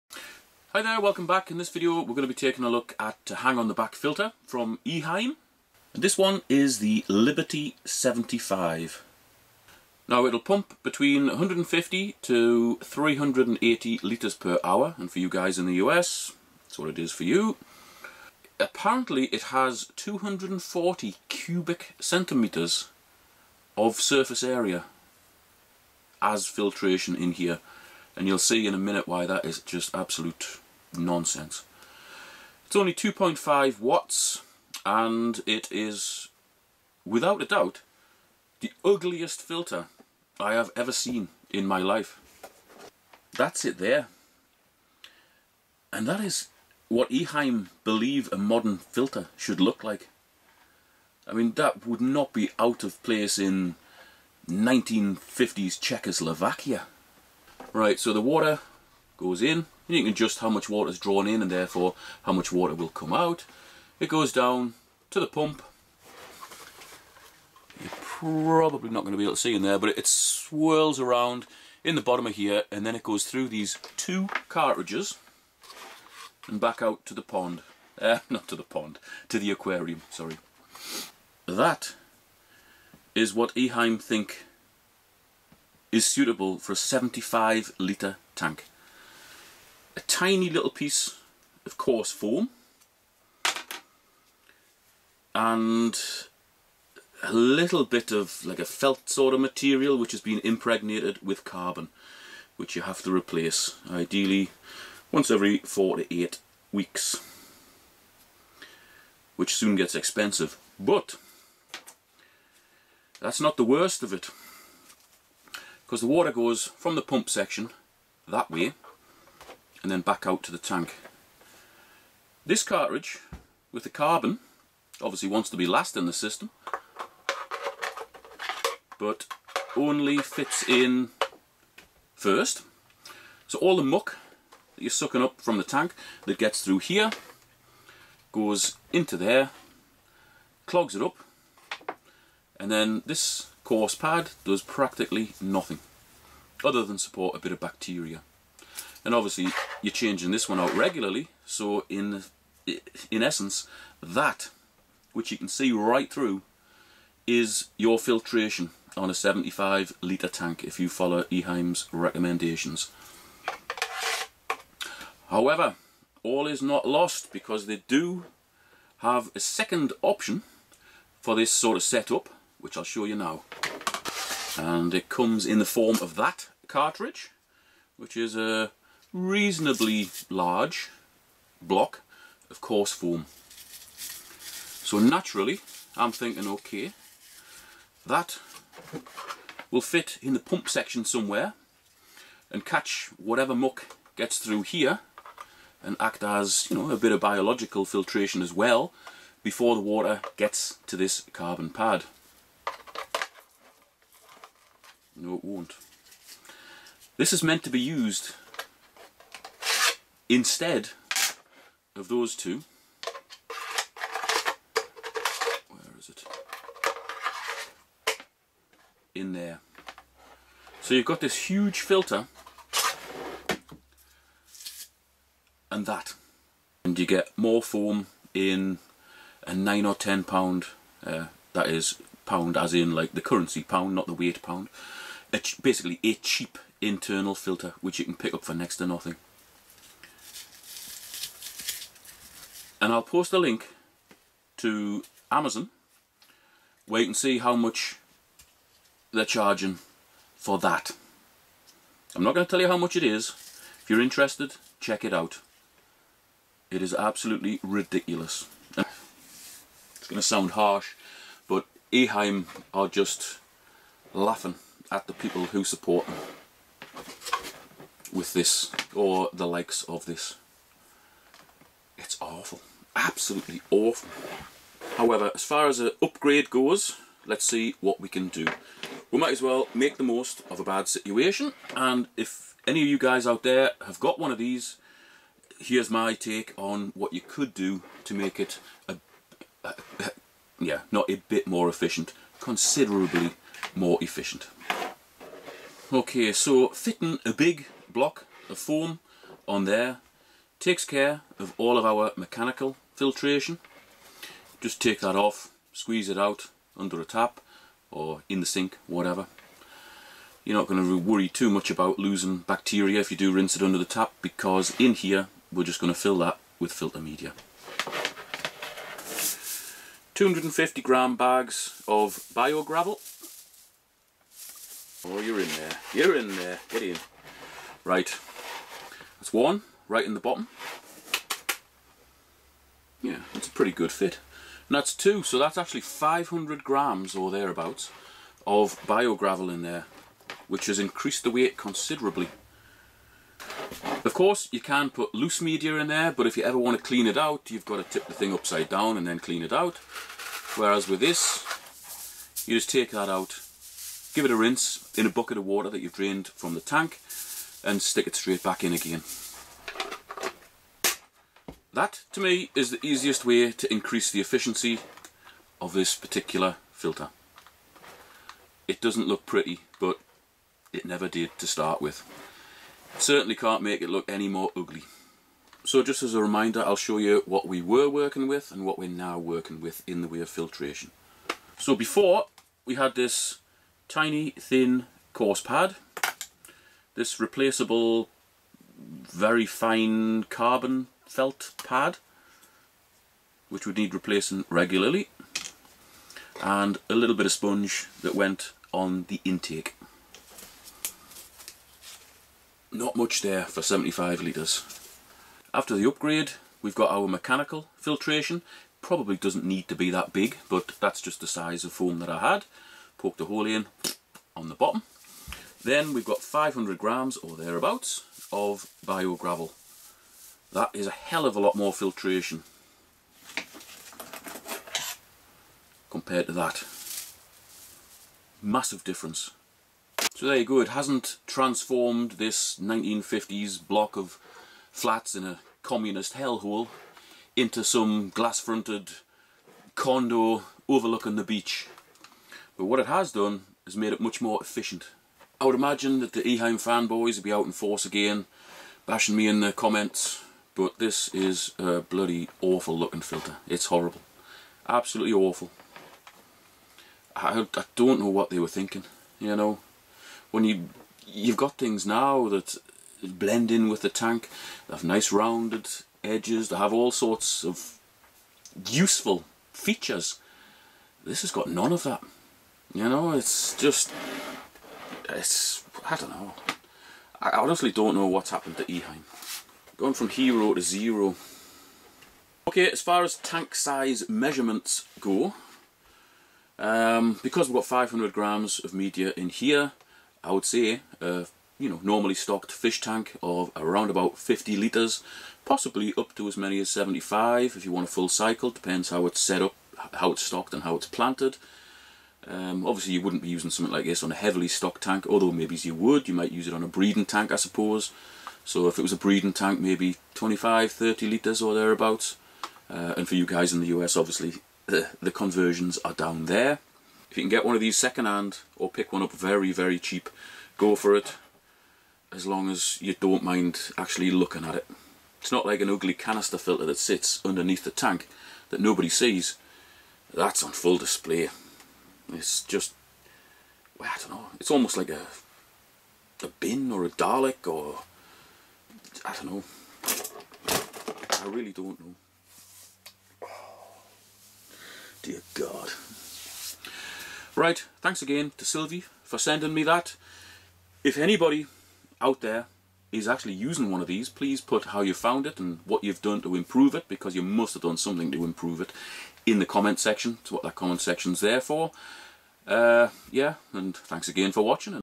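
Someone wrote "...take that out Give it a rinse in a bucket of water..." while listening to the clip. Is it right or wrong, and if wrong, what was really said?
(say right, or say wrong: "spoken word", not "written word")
right.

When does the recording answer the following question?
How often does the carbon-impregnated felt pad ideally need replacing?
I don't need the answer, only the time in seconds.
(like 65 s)
105 s.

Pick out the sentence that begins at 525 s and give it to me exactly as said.
It's not like an ugly canister filter that sits underneath the tank that nobody sees.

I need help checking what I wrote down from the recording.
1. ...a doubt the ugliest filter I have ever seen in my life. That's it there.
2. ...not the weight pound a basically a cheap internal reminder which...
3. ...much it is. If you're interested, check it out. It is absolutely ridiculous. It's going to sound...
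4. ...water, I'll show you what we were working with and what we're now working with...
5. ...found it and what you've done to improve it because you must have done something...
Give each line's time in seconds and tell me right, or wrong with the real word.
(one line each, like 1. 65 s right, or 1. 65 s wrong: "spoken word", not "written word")
1. 37 s right
2. 233 s wrong: "filter", not "reminder"
3. 252 s right
4. 376 s wrong: "reminder", not "water"
5. 554 s right.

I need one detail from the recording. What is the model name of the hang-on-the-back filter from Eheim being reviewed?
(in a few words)
Liberty 75.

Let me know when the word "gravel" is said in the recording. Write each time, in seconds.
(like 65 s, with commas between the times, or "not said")
322 s, 339 s, 419 s.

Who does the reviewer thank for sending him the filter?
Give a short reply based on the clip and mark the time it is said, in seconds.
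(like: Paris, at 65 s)
Sylvie, at 548 s.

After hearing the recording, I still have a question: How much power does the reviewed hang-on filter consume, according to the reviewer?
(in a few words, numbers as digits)
2.5 watts.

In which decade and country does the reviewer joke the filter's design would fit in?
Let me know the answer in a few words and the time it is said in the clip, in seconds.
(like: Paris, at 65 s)
1950s Czechoslovakia, at 54 s.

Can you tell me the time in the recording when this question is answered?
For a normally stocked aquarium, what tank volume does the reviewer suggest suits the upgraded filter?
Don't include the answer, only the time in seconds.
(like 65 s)
494 s.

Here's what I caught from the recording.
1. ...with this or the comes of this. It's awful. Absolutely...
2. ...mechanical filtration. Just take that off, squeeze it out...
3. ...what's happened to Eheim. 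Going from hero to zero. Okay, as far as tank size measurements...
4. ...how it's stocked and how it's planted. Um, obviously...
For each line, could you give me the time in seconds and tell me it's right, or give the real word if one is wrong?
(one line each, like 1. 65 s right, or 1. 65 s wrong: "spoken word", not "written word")
1. 268 s wrong: "likes", not "comes"
2. 302 s right
3. 478 s right
4. 499 s right.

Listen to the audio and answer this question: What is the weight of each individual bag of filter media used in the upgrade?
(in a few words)
250 grams.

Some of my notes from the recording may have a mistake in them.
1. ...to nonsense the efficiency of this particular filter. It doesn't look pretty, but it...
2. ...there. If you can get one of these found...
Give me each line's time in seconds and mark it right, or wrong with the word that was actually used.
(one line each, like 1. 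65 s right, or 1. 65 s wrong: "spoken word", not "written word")
1. 363 s wrong: "increase", not "nonsense"
2. 516 s wrong: "secondhand", not "found".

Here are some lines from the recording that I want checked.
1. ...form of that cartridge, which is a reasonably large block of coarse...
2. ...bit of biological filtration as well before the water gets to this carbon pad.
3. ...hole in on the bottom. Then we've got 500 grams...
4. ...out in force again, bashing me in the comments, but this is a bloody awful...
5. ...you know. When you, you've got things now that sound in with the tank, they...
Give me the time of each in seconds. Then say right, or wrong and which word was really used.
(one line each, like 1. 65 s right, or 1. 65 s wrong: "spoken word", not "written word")
1. 175 s right
2. 196 s right
3. 413 s right
4. 447 s right
5. 459 s wrong: "blend", not "sound".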